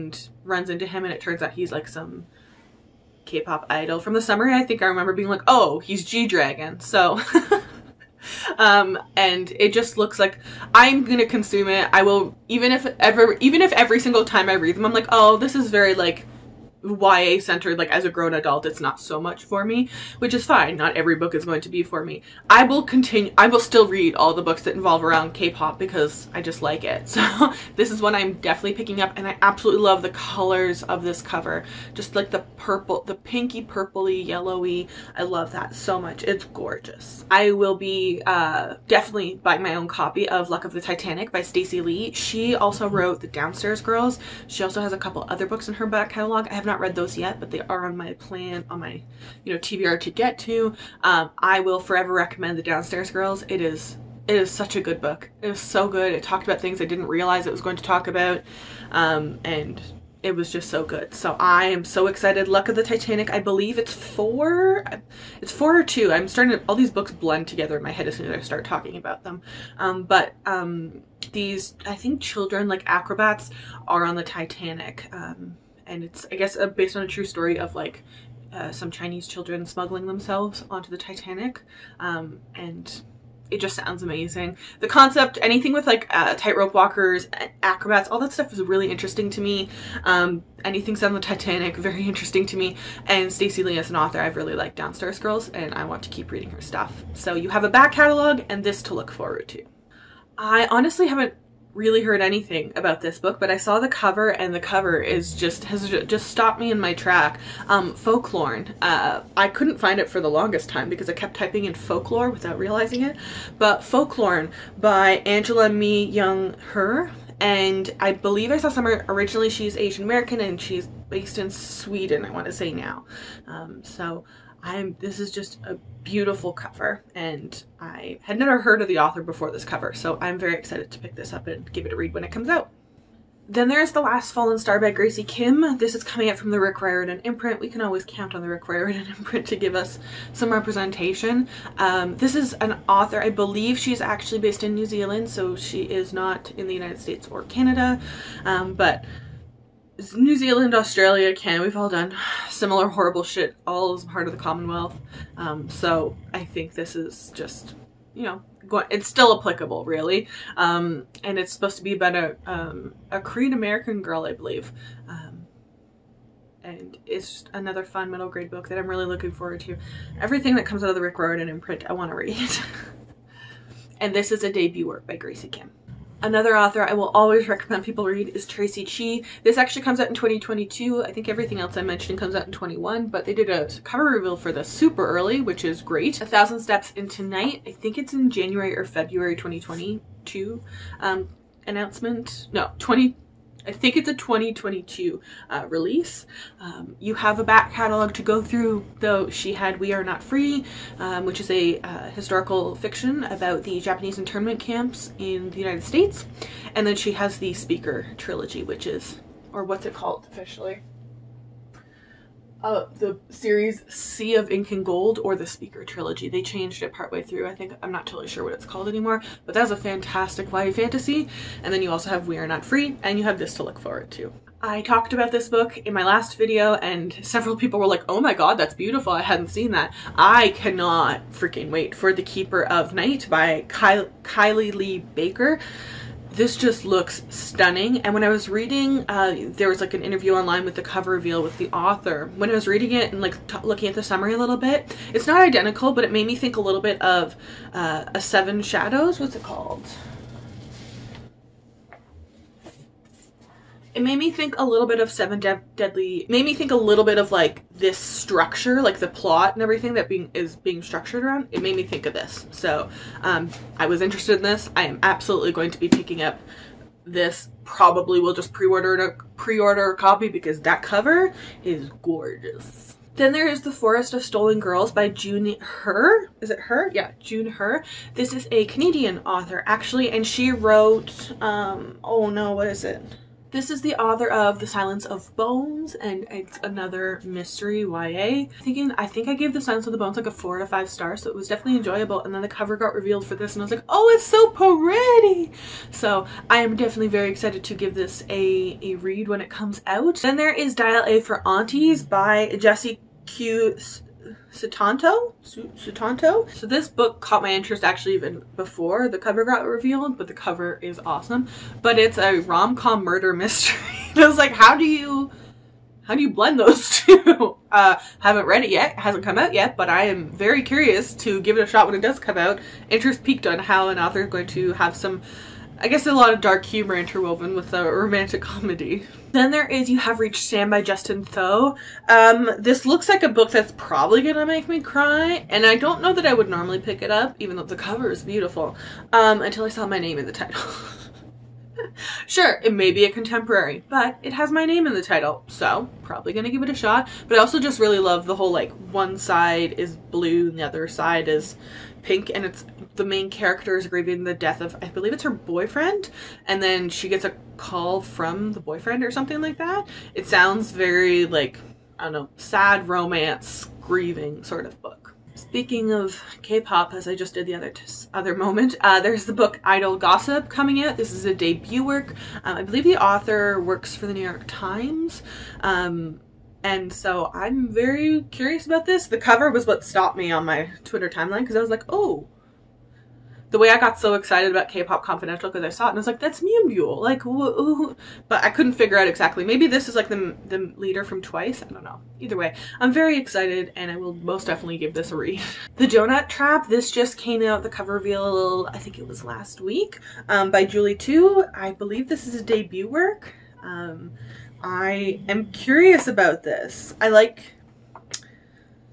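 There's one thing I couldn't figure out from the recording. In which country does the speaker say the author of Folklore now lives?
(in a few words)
Sweden.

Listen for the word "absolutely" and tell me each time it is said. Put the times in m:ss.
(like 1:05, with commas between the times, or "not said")
0:29, 4:25.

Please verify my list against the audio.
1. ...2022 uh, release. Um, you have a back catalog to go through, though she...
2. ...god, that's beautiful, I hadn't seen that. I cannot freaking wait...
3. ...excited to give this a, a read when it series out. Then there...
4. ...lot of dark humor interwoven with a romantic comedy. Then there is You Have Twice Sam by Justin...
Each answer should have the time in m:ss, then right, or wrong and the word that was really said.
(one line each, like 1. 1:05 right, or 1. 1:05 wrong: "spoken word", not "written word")
1. 3:14 right
2. 3:48 right
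3. 4:57 wrong: "comes", not "series"
4. 5:26 wrong: "Reached", not "Twice".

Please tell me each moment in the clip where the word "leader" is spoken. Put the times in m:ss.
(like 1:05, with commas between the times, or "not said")
6:30.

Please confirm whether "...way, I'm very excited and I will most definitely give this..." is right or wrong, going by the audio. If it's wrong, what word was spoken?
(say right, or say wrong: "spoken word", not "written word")
right.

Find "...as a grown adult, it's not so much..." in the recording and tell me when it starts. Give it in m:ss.
0:17.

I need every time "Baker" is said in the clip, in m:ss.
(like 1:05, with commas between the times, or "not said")
3:55.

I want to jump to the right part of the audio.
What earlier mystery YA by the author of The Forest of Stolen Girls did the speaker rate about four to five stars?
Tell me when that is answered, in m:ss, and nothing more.
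4:44.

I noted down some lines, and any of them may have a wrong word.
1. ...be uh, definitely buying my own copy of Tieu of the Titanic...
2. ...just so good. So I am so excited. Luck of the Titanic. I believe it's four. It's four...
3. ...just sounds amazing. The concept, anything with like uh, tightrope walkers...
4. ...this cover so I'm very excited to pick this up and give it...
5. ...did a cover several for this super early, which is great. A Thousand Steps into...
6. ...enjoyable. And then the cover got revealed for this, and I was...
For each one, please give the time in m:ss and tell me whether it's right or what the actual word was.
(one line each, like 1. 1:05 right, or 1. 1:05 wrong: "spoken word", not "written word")
1. 0:37 wrong: "Luck", not "Tieu"
2. 1:00 right
3. 1:23 right
4. 2:09 right
5. 3:03 wrong: "reveal", not "several"
6. 4:51 right.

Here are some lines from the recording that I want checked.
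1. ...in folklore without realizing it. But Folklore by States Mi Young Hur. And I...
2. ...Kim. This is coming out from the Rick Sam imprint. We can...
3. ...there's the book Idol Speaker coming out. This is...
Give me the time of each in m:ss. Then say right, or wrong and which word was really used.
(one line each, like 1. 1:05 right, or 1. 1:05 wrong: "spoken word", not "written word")
1. 1:51 wrong: "Angela", not "States"
2. 2:15 wrong: "Riordan", not "Sam"
3. 6:08 wrong: "Gossip", not "Speaker".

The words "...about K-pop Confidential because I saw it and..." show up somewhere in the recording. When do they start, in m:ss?
6:24.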